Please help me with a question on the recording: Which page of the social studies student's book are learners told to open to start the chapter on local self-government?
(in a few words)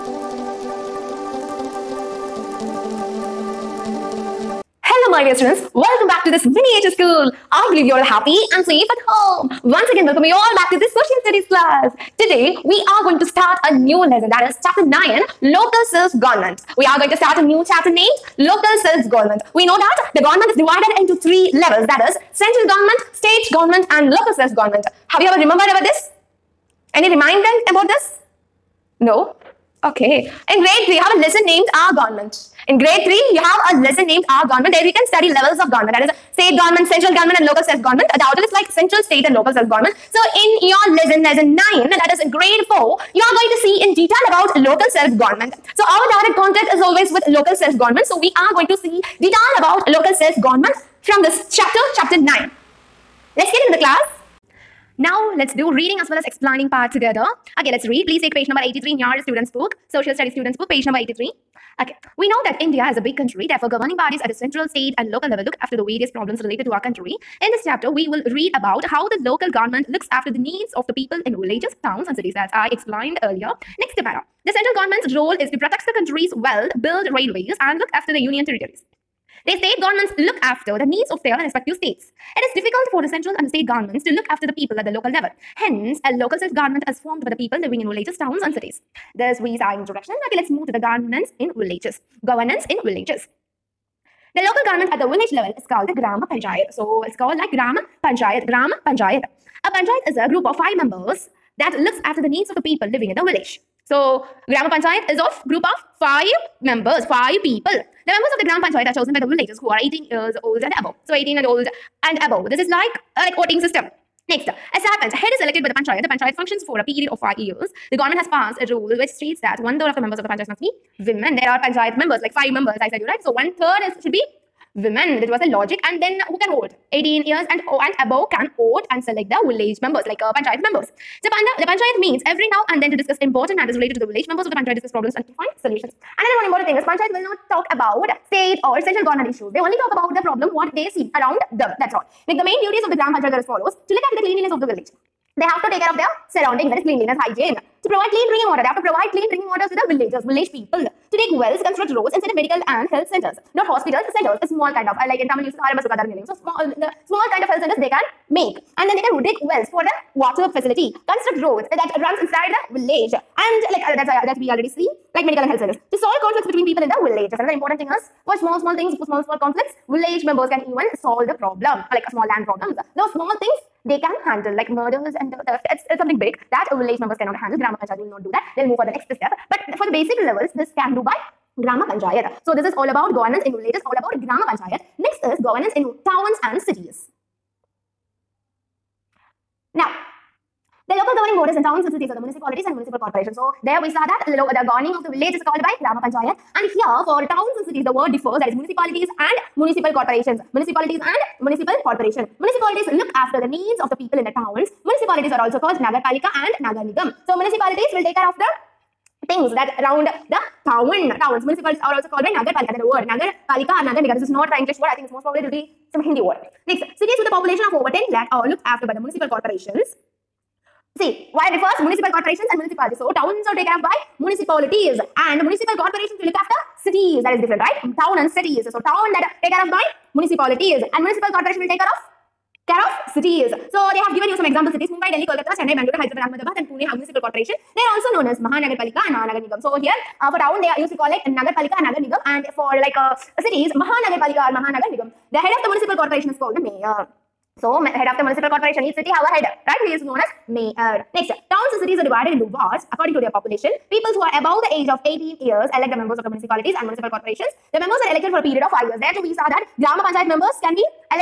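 83.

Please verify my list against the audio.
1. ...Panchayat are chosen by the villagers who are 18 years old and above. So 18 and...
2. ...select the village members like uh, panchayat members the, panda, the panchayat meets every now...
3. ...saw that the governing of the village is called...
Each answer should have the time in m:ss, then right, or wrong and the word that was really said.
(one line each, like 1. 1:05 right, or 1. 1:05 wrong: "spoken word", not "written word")
1. 1:48 right
2. 2:09 right
3. 3:13 right.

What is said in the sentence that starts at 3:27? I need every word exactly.
So municipalities will take care of the things that round the town.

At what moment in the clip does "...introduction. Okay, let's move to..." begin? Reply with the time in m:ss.
1:29.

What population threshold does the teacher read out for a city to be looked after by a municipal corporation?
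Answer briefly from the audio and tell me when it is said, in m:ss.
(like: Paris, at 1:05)
over 10 lakh, at 3:37.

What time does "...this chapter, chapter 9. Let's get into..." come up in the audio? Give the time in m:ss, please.
0:51.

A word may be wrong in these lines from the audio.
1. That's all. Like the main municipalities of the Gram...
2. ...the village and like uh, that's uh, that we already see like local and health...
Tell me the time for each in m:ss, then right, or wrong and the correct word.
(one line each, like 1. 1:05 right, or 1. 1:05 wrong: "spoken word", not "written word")
1. 2:21 wrong: "duties", not "municipalities"
2. 2:42 wrong: "medical", not "local".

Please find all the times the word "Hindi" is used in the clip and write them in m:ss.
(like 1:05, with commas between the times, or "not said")
3:36.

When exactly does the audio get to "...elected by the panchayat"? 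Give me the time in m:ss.
1:55.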